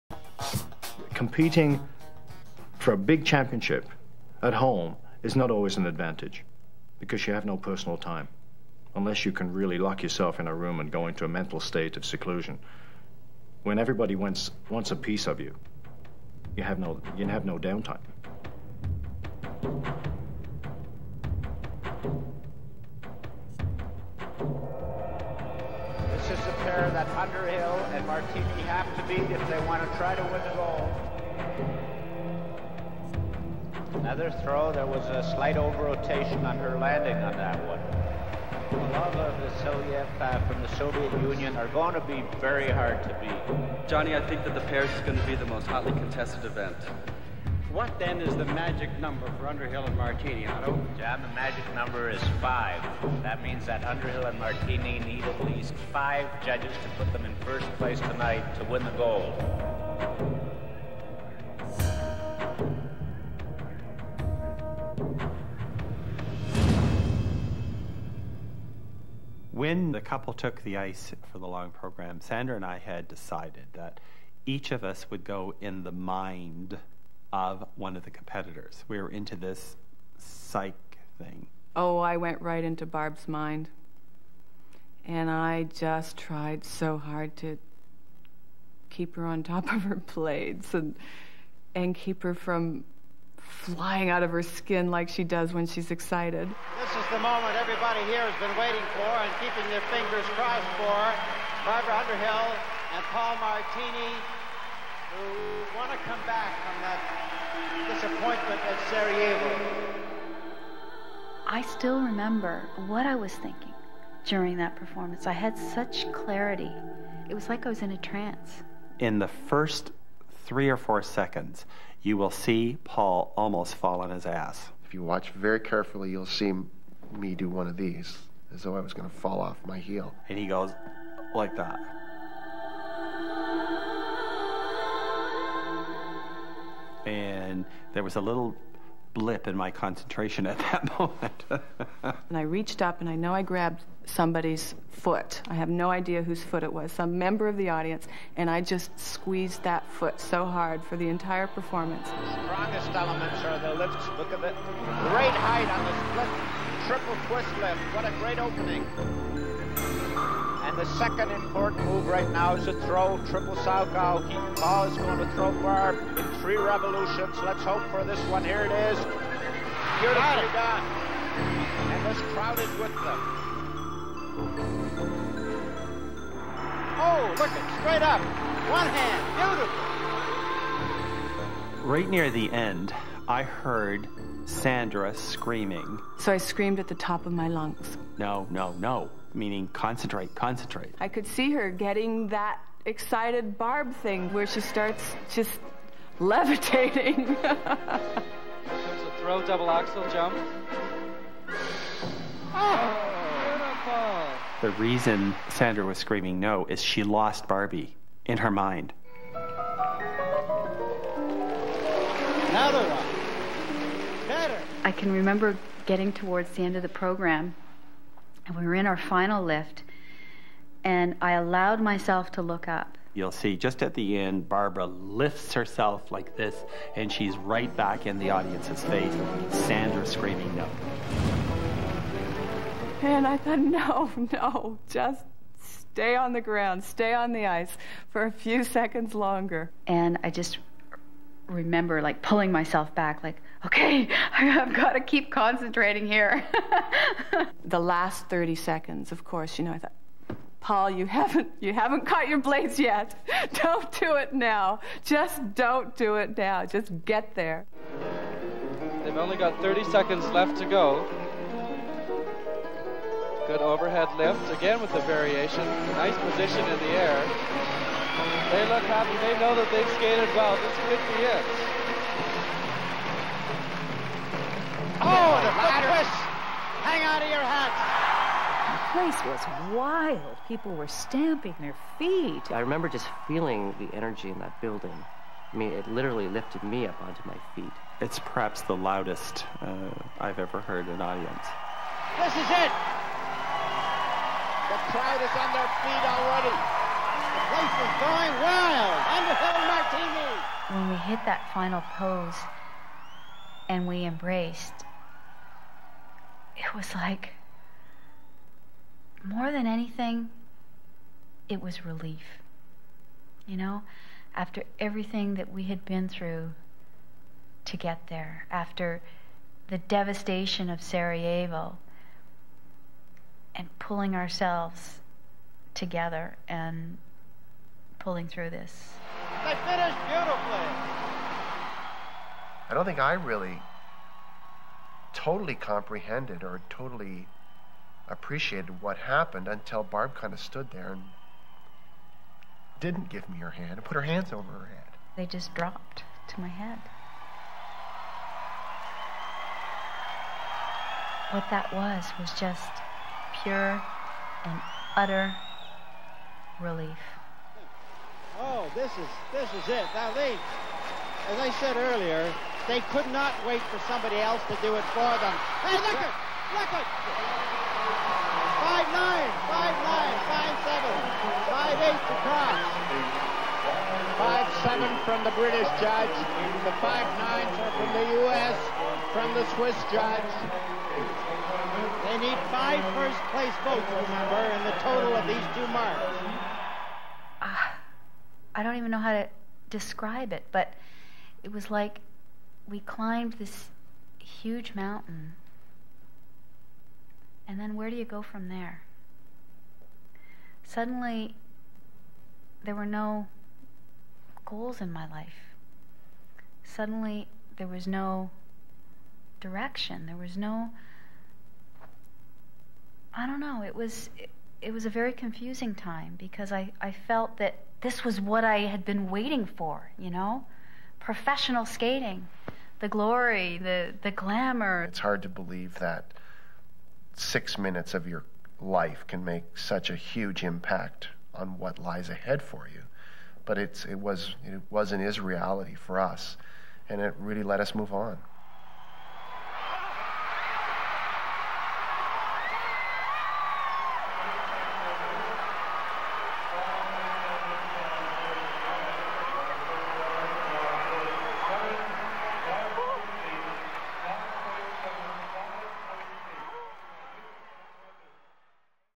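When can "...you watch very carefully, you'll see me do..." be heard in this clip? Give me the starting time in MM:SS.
02:04.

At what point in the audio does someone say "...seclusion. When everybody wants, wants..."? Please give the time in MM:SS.
00:12.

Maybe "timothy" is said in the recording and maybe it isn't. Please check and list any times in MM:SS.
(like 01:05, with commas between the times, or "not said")
not said.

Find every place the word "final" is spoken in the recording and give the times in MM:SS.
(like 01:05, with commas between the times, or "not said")
03:38, 05:01.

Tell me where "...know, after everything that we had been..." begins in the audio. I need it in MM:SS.
05:13.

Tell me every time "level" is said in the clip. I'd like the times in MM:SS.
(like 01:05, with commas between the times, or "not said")
not said.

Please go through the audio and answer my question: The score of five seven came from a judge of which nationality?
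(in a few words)
British.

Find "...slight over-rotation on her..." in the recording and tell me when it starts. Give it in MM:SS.
00:35.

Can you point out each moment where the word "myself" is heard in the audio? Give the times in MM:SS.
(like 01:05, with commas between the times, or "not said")
03:41, 04:02.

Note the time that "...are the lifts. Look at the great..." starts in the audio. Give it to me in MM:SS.
02:33.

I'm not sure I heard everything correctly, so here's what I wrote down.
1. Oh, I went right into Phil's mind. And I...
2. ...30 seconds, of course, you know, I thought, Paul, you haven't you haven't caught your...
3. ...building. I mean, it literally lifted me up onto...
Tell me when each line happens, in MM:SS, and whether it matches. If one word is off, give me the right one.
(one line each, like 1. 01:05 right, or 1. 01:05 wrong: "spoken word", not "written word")
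1. 01:21 wrong: "Barb", not "Phil"
2. 04:08 right
3. 04:44 right.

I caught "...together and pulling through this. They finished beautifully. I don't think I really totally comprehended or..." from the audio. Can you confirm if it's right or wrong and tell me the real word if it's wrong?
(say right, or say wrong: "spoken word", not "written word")
right.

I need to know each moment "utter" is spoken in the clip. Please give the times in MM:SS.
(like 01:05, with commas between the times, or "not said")
05:54.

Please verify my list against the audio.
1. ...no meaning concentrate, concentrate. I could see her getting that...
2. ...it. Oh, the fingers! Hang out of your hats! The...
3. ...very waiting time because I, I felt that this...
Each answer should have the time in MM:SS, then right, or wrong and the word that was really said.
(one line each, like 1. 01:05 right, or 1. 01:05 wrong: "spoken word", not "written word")
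1. 03:08 right
2. 04:31 wrong: "ladders", not "fingers"
3. 06:54 wrong: "confusing", not "waiting".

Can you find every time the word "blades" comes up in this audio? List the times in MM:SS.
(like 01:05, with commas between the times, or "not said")
01:29, 04:12.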